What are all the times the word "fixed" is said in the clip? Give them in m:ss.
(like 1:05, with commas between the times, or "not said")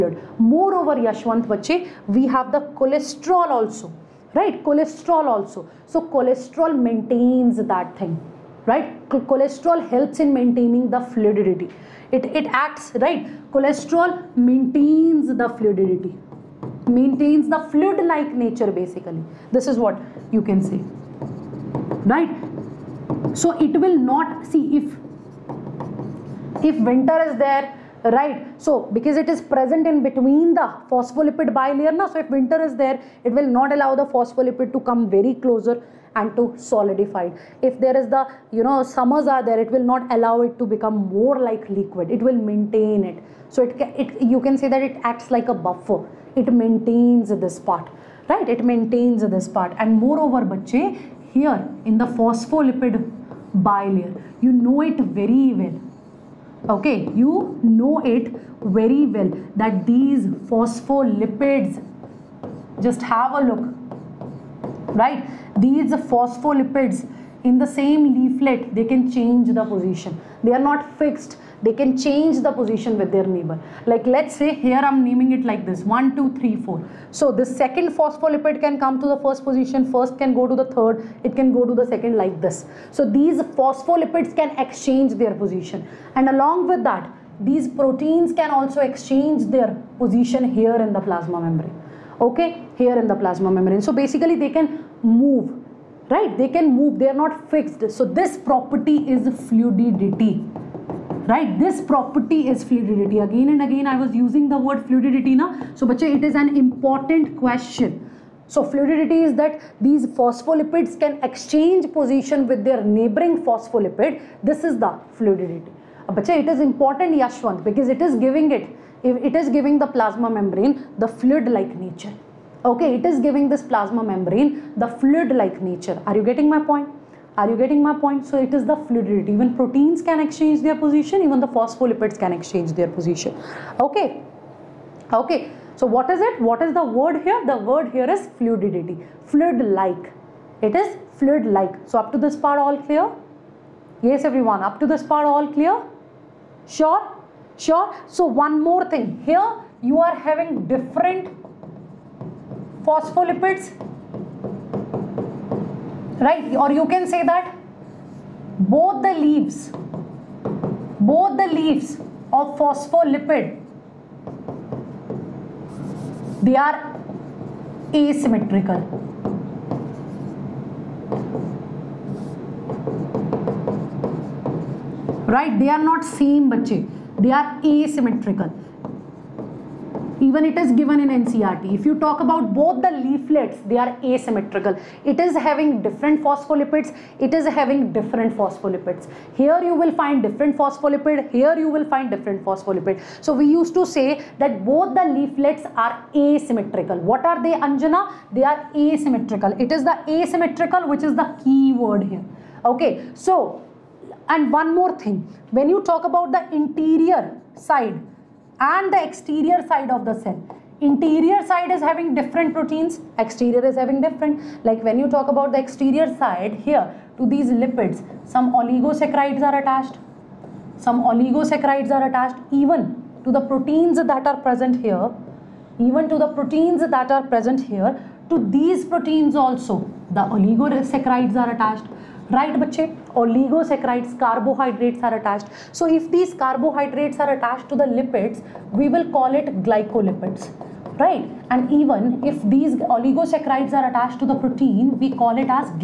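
1:10, 1:37.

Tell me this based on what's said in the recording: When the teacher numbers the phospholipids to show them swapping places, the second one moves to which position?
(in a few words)
first position.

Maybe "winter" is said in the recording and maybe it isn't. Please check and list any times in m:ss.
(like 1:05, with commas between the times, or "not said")
0:26, 0:32.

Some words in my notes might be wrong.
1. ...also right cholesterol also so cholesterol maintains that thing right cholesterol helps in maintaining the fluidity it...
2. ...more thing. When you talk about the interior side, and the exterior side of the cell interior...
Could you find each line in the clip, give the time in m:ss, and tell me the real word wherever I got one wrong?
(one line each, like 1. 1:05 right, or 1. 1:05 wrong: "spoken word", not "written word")
1. 0:03 right
2. 3:24 right.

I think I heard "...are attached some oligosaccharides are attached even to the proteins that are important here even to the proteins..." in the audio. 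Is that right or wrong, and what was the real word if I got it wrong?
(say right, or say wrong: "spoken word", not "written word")
wrong: "present", not "important".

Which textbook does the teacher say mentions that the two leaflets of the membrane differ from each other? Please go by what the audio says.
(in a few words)
NCERT.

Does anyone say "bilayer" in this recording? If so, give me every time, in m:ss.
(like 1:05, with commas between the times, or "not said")
0:31, 0:53.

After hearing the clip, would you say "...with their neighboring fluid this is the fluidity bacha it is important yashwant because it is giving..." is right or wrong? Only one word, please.
wrong.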